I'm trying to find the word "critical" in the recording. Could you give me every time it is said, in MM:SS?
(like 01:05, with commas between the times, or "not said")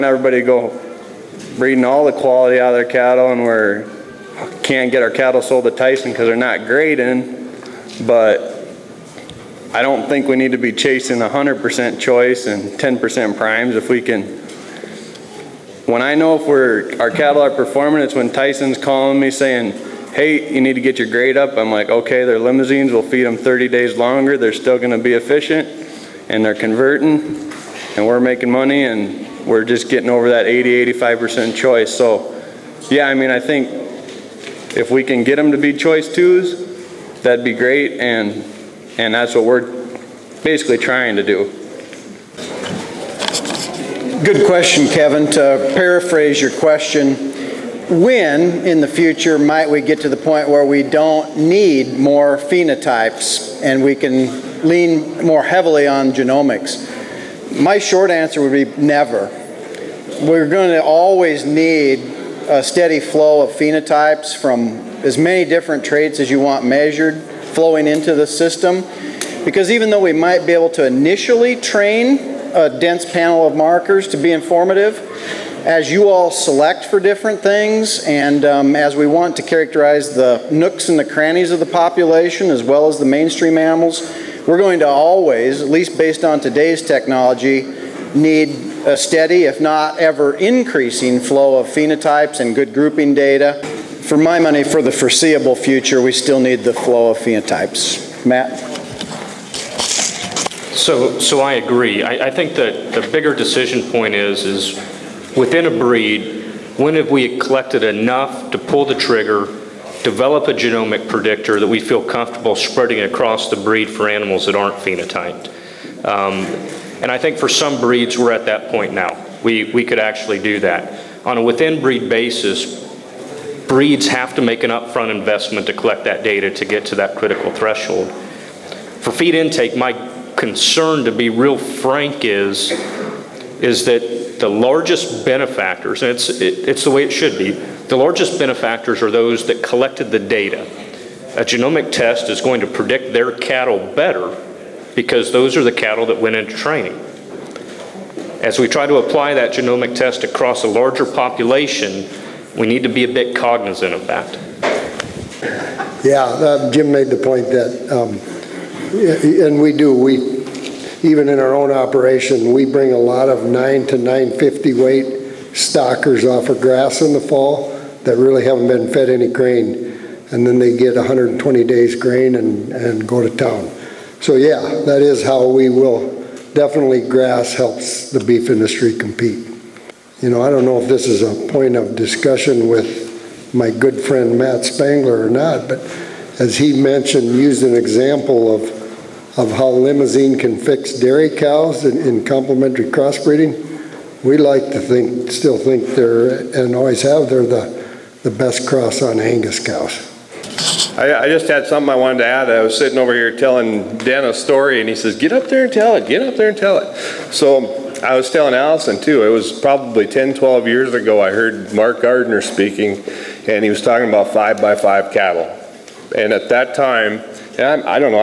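02:07.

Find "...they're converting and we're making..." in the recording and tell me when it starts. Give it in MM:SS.
00:26.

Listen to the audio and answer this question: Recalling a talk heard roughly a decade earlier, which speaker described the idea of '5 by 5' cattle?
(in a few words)
Mark Gardner.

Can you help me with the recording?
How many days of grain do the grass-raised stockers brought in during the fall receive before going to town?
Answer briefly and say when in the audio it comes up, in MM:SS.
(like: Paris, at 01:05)
120, at 02:50.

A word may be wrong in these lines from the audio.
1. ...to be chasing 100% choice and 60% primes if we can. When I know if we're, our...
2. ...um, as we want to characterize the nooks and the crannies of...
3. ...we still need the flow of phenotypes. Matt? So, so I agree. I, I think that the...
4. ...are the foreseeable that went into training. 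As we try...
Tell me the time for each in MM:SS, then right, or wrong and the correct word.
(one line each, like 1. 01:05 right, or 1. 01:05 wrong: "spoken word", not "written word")
1. 00:10 wrong: "10", not "60"
2. 01:18 right
3. 01:36 right
4. 02:25 wrong: "cattle", not "foreseeable".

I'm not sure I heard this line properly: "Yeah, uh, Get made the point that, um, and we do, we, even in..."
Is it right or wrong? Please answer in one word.
wrong.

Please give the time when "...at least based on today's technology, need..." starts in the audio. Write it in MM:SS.
01:25.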